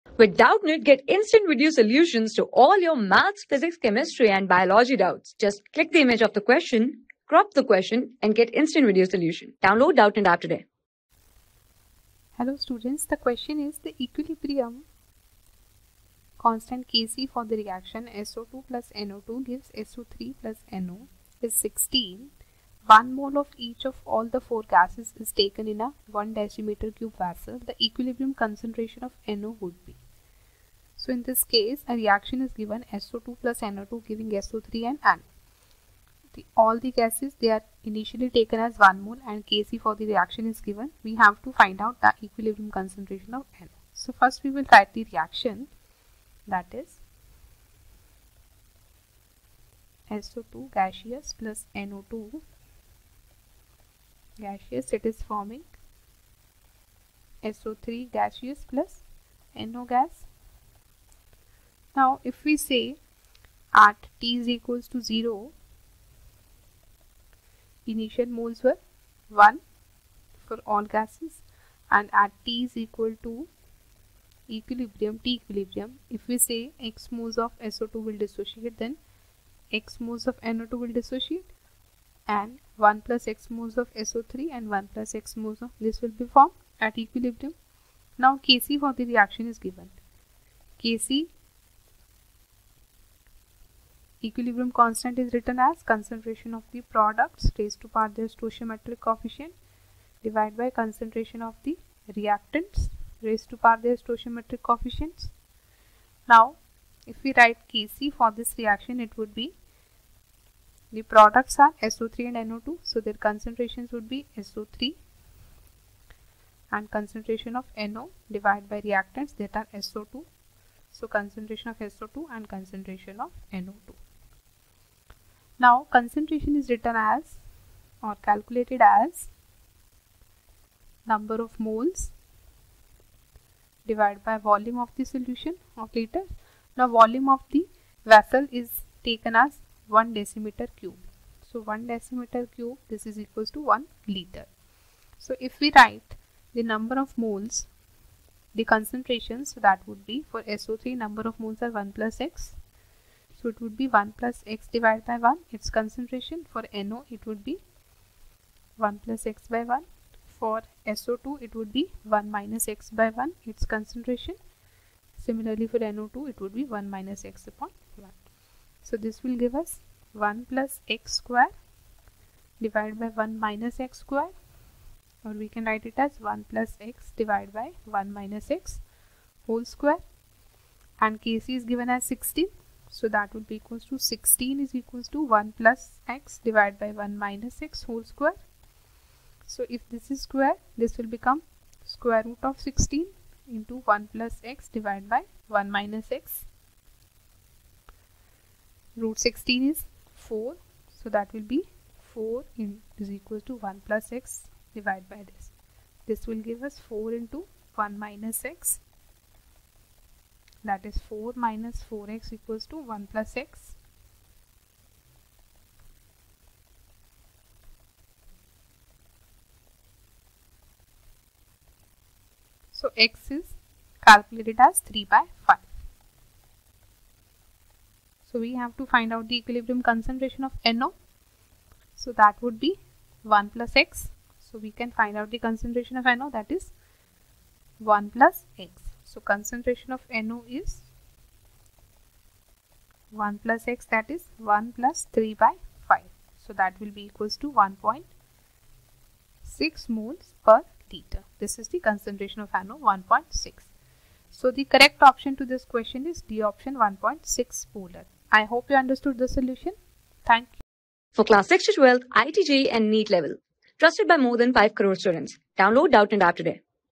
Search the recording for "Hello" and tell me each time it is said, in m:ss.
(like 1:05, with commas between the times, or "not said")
0:12.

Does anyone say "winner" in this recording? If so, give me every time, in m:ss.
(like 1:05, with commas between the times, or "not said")
not said.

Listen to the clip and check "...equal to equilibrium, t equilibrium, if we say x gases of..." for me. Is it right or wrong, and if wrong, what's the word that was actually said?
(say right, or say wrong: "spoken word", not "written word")
wrong: "moles", not "gases".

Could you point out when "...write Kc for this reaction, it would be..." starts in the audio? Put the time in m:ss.
1:47.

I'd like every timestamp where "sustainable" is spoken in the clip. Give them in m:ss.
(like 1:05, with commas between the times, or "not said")
not said.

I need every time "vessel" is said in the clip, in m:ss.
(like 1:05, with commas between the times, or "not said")
0:27, 2:18.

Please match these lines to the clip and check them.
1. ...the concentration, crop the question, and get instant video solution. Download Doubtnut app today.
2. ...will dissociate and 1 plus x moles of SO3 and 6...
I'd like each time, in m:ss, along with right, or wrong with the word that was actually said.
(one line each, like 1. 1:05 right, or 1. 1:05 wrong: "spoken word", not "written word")
1. 0:06 wrong: "question", not "concentration"
2. 1:20 wrong: "1", not "6".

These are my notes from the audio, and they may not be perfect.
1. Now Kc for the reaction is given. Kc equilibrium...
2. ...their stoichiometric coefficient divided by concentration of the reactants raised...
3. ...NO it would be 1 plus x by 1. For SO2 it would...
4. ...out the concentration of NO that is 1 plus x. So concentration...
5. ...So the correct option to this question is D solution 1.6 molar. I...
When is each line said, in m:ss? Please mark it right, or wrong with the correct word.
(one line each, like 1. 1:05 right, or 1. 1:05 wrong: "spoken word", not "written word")
1. 1:28 right
2. 1:38 right
3. 2:36 right
4. 3:55 right
5. 4:14 wrong: "option", not "solution".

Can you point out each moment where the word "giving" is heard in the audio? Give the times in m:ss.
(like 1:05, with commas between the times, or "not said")
0:34.